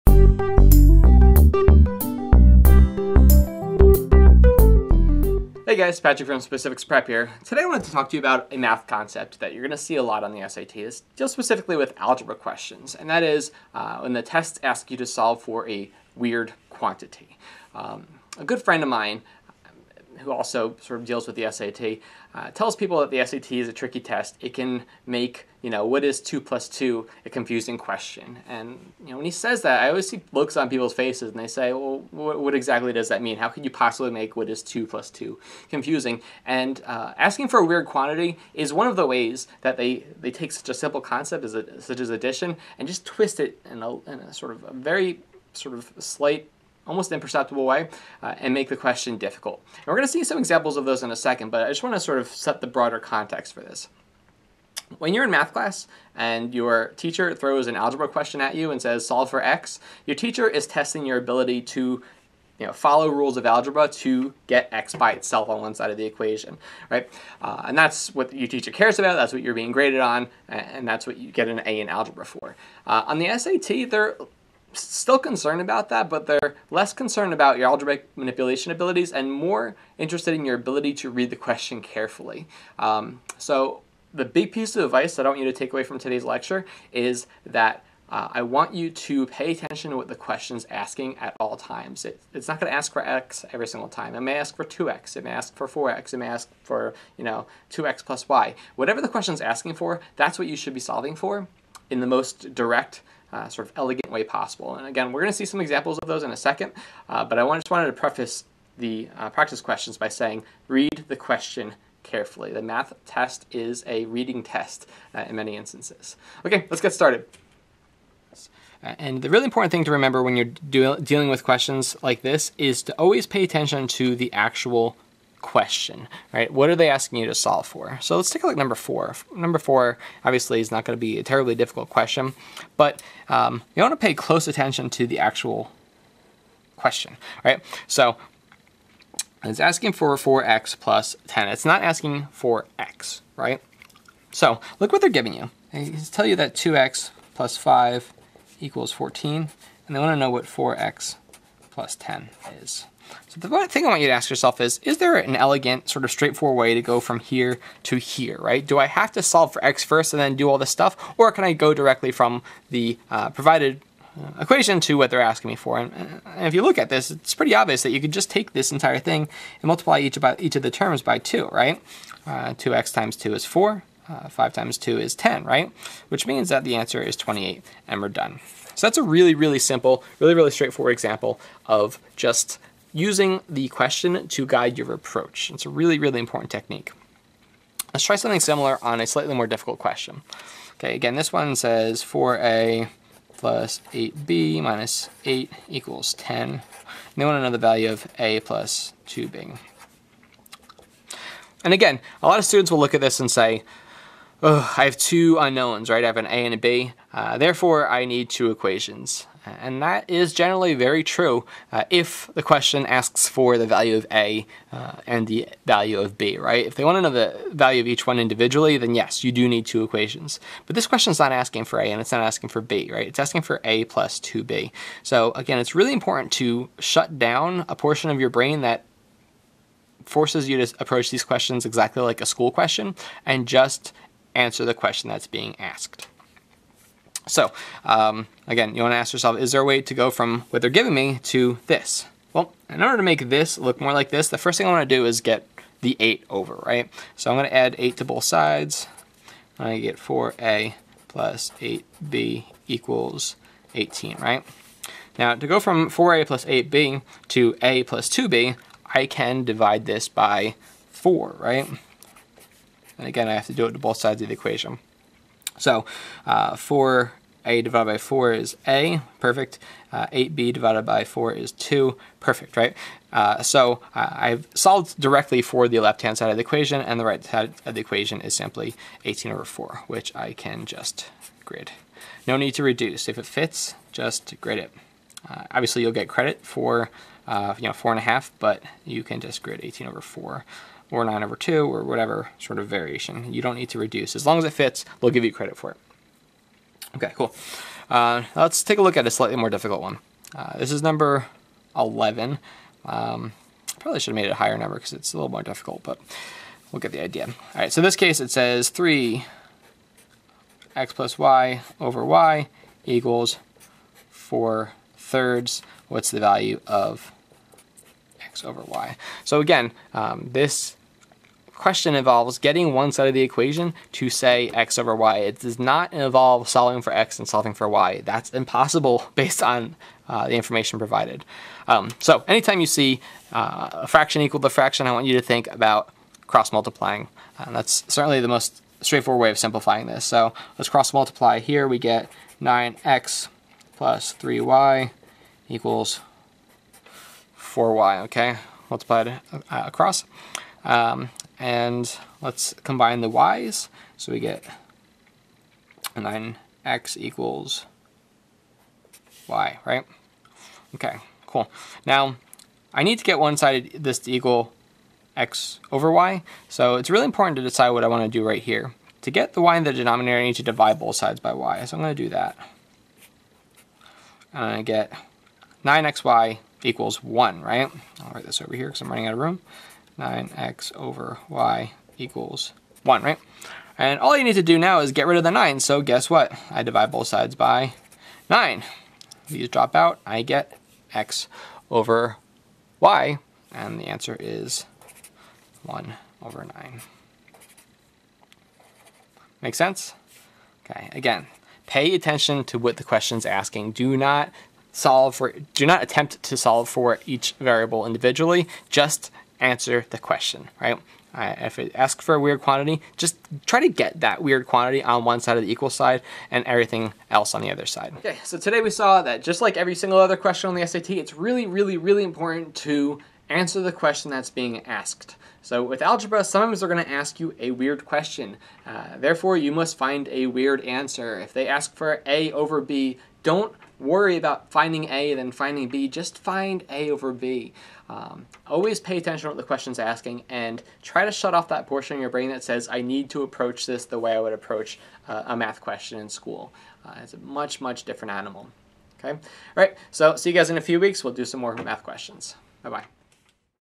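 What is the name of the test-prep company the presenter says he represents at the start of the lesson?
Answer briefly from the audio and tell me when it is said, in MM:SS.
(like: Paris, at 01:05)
Specifix Prep, at 00:06.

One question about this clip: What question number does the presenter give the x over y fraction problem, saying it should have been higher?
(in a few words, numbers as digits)
11.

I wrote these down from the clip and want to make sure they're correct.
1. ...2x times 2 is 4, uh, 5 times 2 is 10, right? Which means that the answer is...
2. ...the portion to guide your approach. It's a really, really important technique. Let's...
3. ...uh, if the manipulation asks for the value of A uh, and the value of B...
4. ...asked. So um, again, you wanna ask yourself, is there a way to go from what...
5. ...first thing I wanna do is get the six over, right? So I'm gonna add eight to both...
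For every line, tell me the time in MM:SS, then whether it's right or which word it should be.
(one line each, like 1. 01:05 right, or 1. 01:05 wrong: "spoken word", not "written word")
1. 02:52 right
2. 03:03 wrong: "question", not "portion"
3. 03:31 wrong: "question", not "manipulation"
4. 03:55 right
5. 04:04 wrong: "eight", not "six".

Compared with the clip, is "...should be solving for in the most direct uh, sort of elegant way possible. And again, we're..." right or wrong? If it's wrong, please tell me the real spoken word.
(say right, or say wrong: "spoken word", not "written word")
right.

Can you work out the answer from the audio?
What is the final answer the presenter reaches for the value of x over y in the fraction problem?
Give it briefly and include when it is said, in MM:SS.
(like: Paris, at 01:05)
1/9, at 06:35.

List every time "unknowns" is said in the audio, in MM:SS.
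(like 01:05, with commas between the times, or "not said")
03:25.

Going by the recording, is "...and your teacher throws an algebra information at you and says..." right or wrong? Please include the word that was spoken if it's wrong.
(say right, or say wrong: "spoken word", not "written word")
wrong: "question", not "information".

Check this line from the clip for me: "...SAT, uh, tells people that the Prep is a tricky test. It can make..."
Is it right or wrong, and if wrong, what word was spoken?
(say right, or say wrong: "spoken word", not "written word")
wrong: "SAT", not "Prep".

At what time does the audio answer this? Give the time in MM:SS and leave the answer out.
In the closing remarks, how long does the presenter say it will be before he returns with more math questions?
07:30.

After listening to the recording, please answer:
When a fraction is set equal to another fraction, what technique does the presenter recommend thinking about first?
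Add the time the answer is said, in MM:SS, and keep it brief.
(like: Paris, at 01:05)
cross multiplying, at 05:36.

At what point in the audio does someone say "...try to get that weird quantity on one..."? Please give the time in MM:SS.
06:53.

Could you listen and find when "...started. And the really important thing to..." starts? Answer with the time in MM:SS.
01:56.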